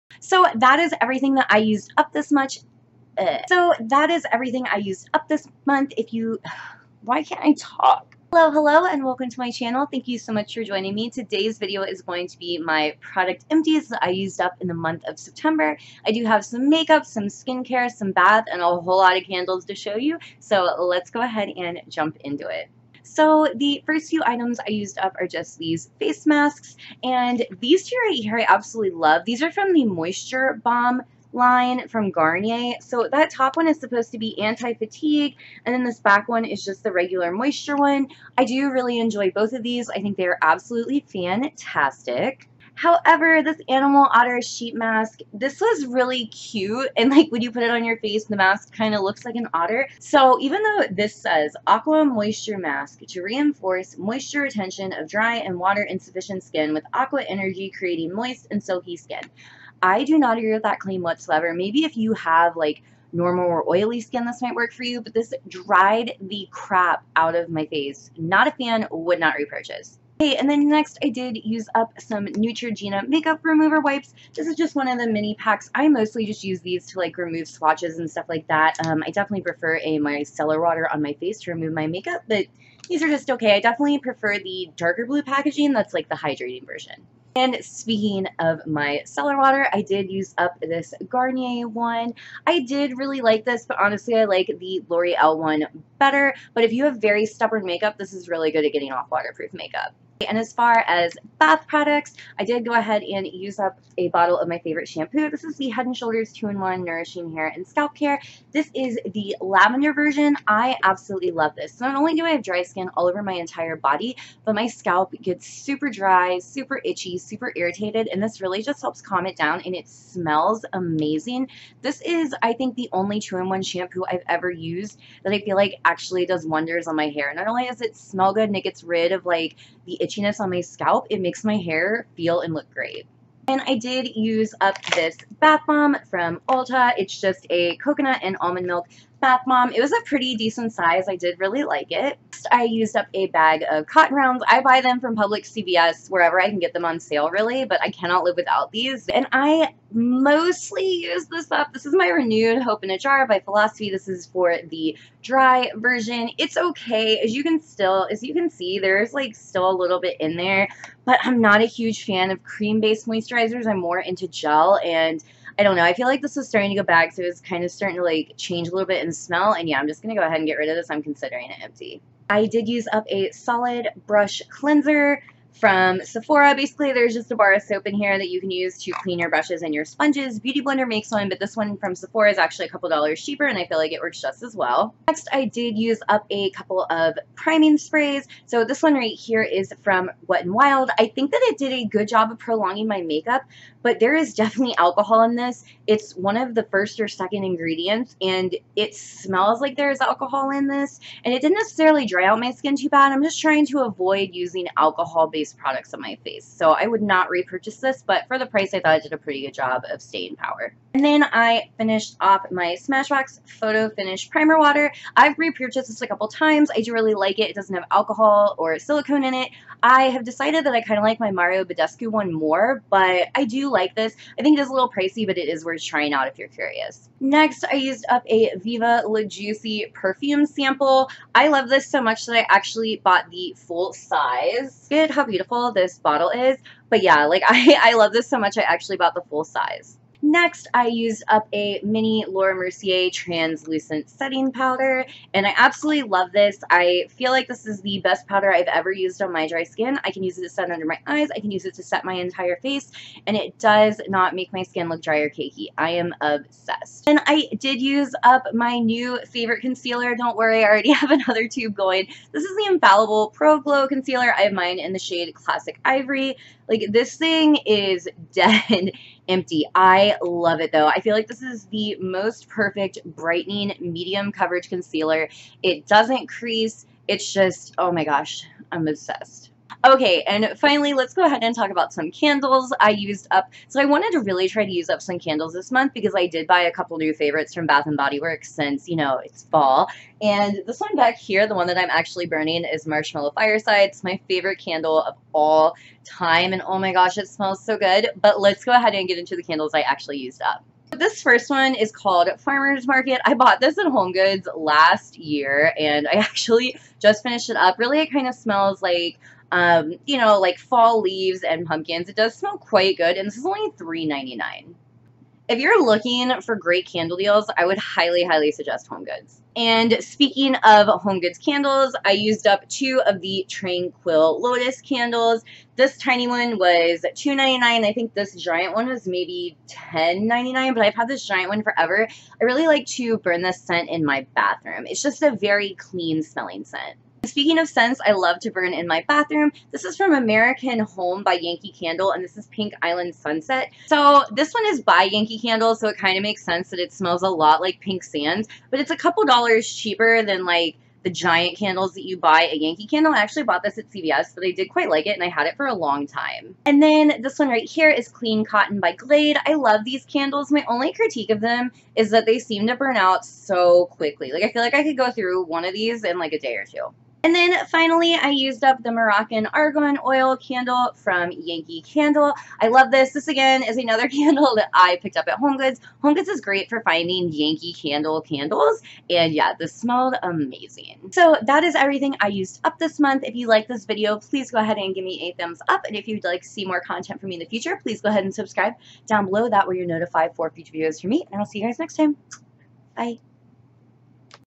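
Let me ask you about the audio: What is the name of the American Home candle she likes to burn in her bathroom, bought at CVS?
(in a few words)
Pink Island Sunset.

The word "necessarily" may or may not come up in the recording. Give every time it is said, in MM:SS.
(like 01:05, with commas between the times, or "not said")
03:21.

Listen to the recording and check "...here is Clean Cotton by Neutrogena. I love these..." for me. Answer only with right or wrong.
wrong.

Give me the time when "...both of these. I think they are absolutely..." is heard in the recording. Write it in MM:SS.
00:39.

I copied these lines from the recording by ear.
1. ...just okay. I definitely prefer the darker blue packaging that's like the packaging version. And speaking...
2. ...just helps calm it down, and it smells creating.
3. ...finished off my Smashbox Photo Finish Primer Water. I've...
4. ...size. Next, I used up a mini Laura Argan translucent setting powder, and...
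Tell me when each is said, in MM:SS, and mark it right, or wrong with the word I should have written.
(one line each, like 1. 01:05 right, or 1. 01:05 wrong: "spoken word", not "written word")
1. 01:23 wrong: "hydrating", not "packaging"
2. 01:58 wrong: "amazing", not "creating"
3. 03:31 right
4. 03:59 wrong: "Mercier", not "Argan".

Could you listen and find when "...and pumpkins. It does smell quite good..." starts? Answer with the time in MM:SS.
05:11.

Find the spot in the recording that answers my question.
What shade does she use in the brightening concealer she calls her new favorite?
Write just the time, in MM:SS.
04:25.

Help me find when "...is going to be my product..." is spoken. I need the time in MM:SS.
00:11.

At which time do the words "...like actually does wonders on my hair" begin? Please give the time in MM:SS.
02:05.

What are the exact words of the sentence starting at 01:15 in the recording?
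I mostly just use these to like remove swatches and stuff like that.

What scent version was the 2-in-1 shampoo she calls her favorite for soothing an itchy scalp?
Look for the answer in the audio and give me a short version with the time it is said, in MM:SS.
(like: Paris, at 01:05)
Lavender, at 01:49.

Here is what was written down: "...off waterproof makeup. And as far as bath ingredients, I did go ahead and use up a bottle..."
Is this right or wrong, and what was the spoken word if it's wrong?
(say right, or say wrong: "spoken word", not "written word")
wrong: "products", not "ingredients".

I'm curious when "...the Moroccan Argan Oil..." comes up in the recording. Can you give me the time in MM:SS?
06:08.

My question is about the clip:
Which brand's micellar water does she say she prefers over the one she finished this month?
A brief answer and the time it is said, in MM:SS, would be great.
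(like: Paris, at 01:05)
L'Oreal, at 01:34.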